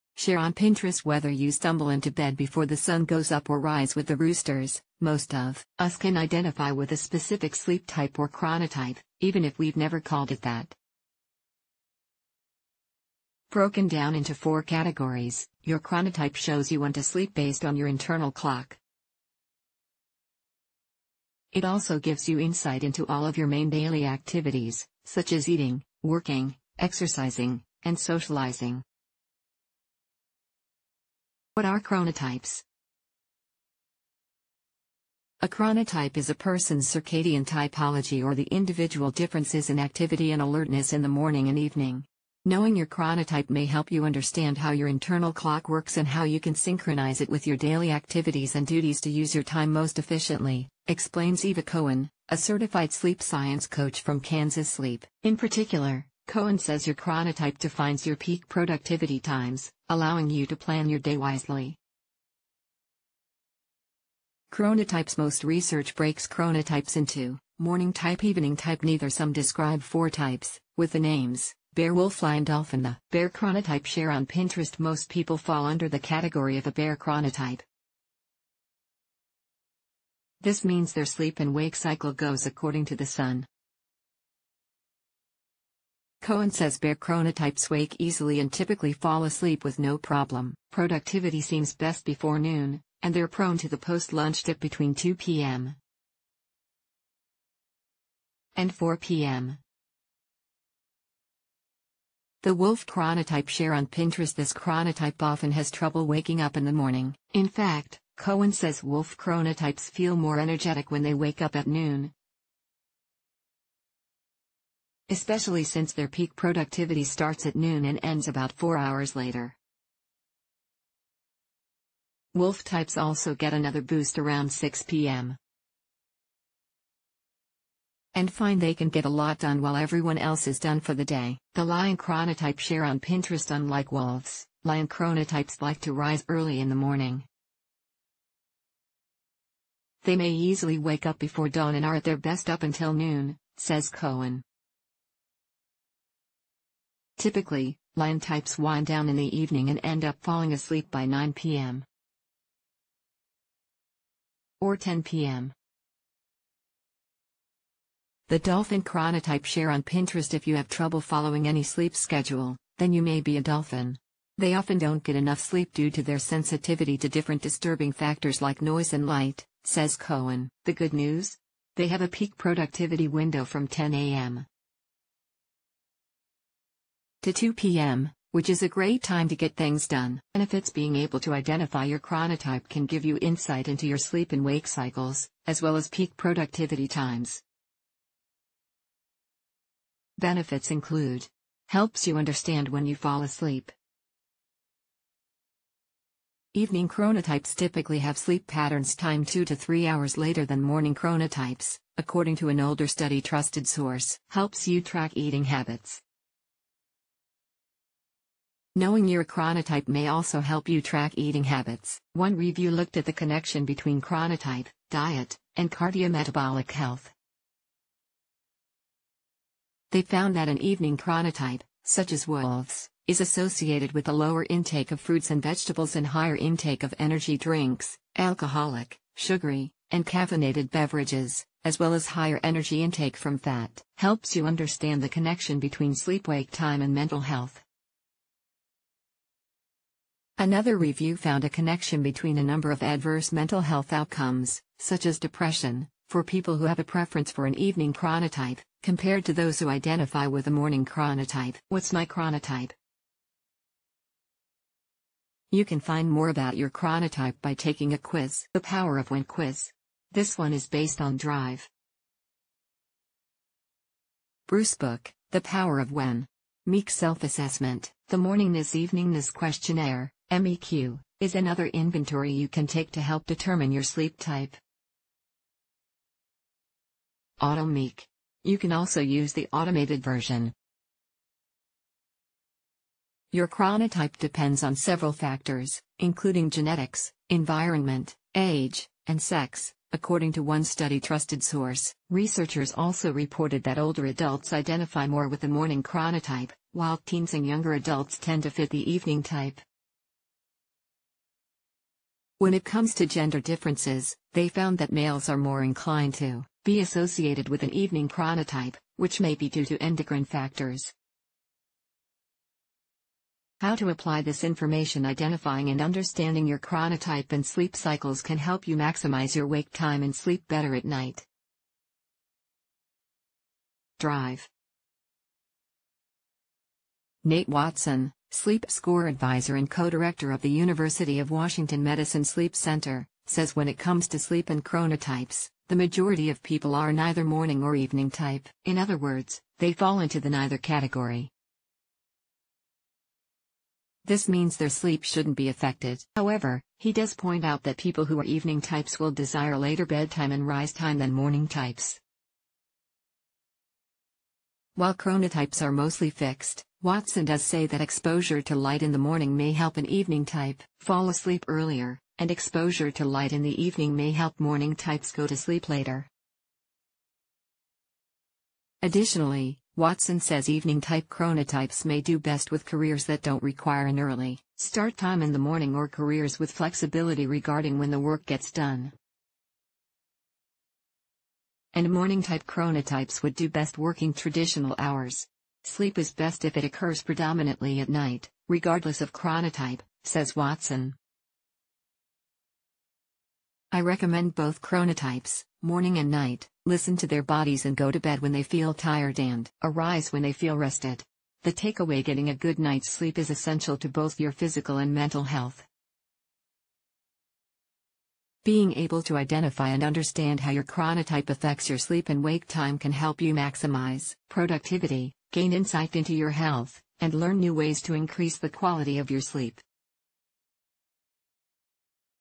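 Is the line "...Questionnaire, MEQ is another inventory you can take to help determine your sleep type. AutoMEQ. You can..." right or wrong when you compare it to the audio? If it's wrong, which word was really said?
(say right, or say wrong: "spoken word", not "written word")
right.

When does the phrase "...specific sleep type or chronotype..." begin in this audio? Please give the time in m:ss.
0:06.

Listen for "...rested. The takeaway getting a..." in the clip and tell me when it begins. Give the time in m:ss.
6:40.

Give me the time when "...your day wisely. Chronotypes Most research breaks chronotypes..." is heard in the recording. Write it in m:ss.
1:00.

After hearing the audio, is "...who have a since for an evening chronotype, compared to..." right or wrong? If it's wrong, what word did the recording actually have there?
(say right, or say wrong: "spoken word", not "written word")
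wrong: "preference", not "since".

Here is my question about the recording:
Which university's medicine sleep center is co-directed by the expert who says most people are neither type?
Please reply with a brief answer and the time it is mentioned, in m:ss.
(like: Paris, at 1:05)
University of Washington, at 5:30.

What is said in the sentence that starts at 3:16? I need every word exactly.
Evening chronotypes typically have sleep patterns timed 2 to 3 hours later than morning chronotypes, according to an older study trusted source.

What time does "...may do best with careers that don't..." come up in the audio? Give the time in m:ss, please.
6:11.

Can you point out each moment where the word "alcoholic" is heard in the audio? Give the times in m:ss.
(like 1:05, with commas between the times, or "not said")
3:48.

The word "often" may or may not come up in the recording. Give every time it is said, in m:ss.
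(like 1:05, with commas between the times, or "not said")
1:45, 2:44.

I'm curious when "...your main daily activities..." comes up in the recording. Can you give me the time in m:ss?
0:23.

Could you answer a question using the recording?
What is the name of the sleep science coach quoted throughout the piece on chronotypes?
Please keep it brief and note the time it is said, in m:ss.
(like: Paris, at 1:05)
Eva Cohen, at 0:51.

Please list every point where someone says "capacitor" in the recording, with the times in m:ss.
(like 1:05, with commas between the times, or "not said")
not said.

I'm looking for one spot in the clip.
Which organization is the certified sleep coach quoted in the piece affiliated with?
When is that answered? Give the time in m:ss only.
0:54.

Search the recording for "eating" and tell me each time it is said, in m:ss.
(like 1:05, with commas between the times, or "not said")
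0:25, 3:25, 3:31.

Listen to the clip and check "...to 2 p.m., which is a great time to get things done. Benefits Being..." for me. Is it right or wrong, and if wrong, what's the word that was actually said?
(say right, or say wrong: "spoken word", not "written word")
right.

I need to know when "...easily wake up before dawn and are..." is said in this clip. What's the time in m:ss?
2:20.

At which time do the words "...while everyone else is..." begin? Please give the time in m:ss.
2:09.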